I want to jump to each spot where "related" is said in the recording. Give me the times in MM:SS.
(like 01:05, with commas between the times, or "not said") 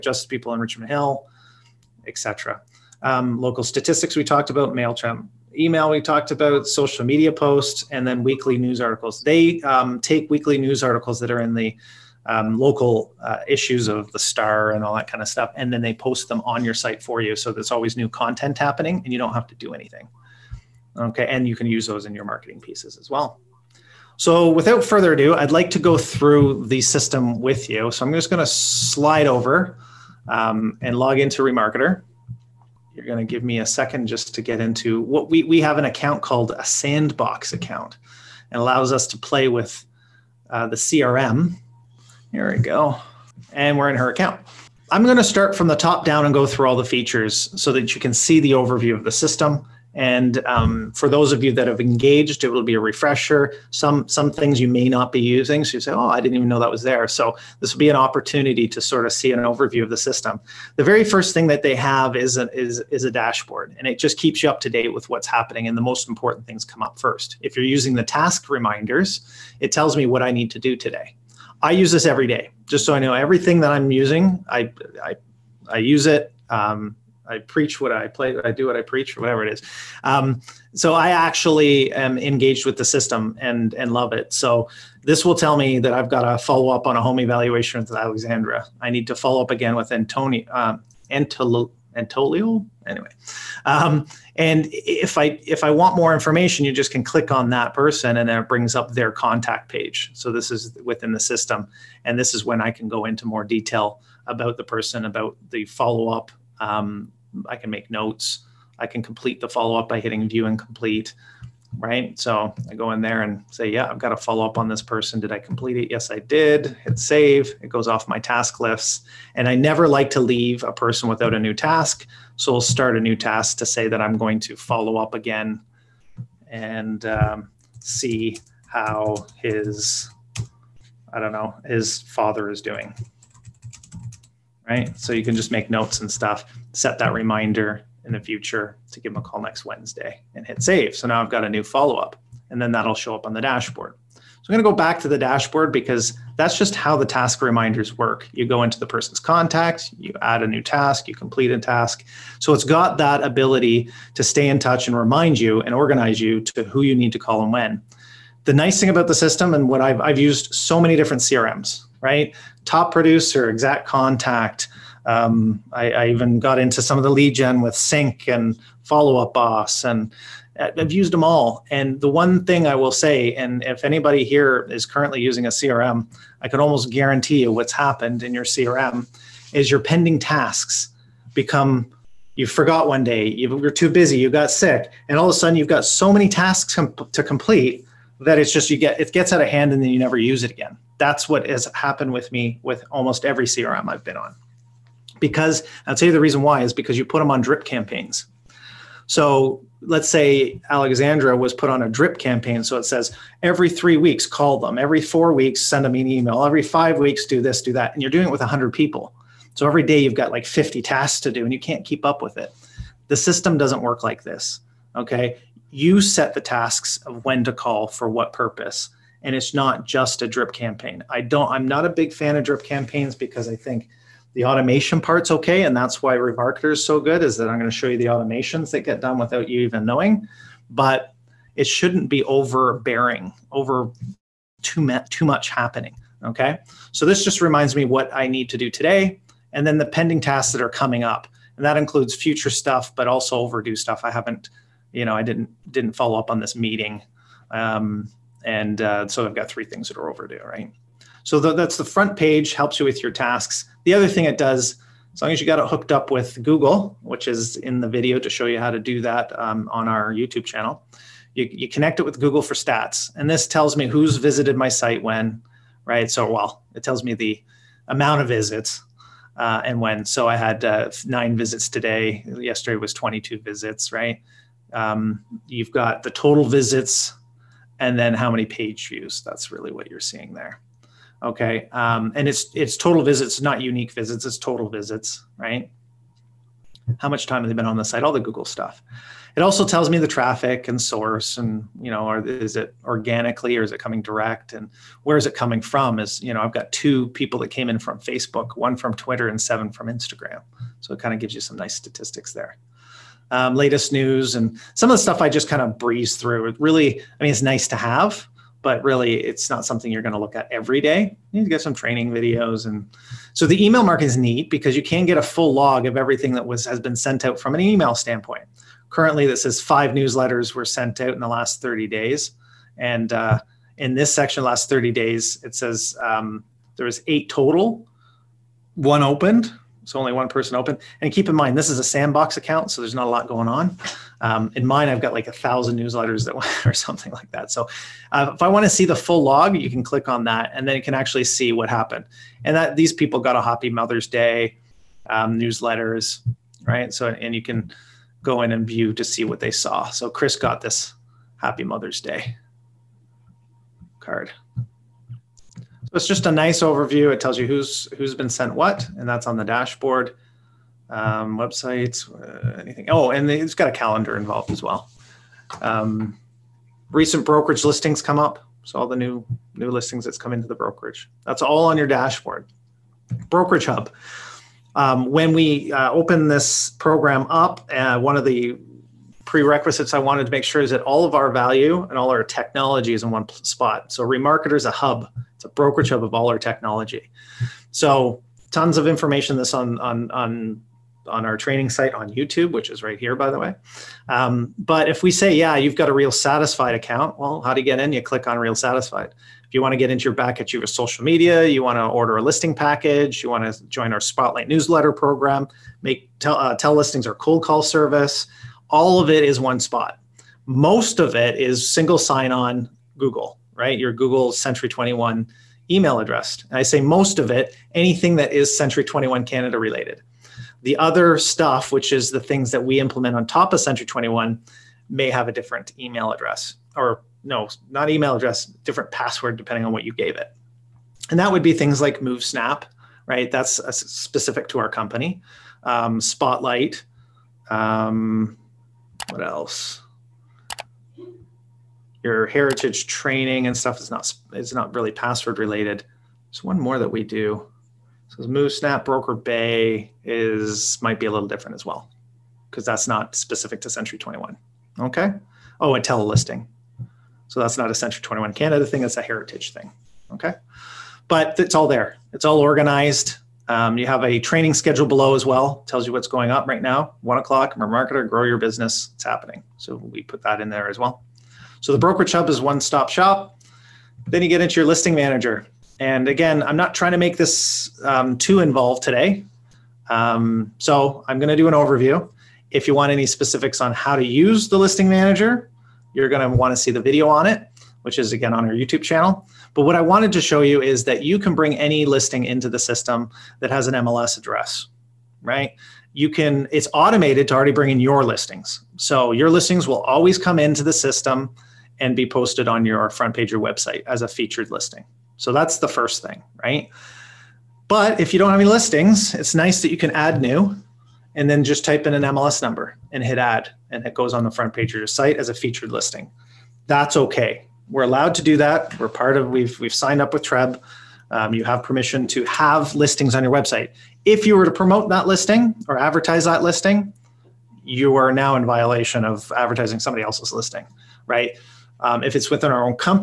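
06:59, 07:25.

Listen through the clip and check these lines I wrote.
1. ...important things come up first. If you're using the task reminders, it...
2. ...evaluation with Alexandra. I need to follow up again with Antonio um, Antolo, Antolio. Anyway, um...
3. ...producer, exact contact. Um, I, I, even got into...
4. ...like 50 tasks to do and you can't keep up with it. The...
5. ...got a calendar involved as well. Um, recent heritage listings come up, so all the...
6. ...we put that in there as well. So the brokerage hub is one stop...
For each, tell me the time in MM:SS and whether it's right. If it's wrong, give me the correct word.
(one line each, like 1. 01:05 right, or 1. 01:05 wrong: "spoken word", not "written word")
1. 01:06 right
2. 01:27 right
3. 02:42 right
4. 03:30 right
5. 06:03 wrong: "brokerage", not "heritage"
6. 07:49 right.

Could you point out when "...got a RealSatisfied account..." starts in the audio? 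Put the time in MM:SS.
06:35.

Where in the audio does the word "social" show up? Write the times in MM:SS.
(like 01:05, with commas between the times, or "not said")
00:06, 06:40.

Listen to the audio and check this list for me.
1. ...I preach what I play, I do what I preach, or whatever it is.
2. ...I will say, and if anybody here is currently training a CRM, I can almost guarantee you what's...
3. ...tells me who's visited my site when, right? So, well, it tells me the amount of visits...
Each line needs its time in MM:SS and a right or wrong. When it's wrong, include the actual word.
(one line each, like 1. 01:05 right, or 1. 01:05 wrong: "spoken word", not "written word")
1. 01:17 right
2. 02:52 wrong: "using", not "training"
3. 04:23 right.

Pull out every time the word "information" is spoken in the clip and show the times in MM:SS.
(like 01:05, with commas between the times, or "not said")
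01:36, 06:28.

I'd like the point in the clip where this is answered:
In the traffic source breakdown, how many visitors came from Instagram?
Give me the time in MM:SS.
04:59.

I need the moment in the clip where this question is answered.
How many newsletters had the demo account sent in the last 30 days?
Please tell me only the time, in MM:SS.
05:19.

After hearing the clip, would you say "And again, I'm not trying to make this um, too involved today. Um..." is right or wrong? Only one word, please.
right.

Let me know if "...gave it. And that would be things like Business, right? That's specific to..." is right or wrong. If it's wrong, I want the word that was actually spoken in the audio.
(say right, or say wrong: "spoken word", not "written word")
wrong: "MoveSnap", not "Business".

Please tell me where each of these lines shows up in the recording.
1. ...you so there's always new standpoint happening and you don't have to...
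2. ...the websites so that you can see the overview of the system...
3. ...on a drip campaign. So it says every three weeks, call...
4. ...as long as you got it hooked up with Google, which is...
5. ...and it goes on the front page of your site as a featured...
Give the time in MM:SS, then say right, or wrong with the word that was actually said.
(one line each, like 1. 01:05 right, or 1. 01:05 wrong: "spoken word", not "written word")
1. 00:17 wrong: "content", not "standpoint"
2. 00:46 wrong: "features", not "websites"
3. 03:21 right
4. 04:15 right
5. 08:33 right.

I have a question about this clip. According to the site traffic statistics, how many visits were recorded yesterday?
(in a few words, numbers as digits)
22.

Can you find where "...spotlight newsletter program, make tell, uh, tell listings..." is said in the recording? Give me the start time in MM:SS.
06:43.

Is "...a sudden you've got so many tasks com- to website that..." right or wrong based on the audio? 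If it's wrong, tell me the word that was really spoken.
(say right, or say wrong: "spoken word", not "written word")
wrong: "complete", not "website".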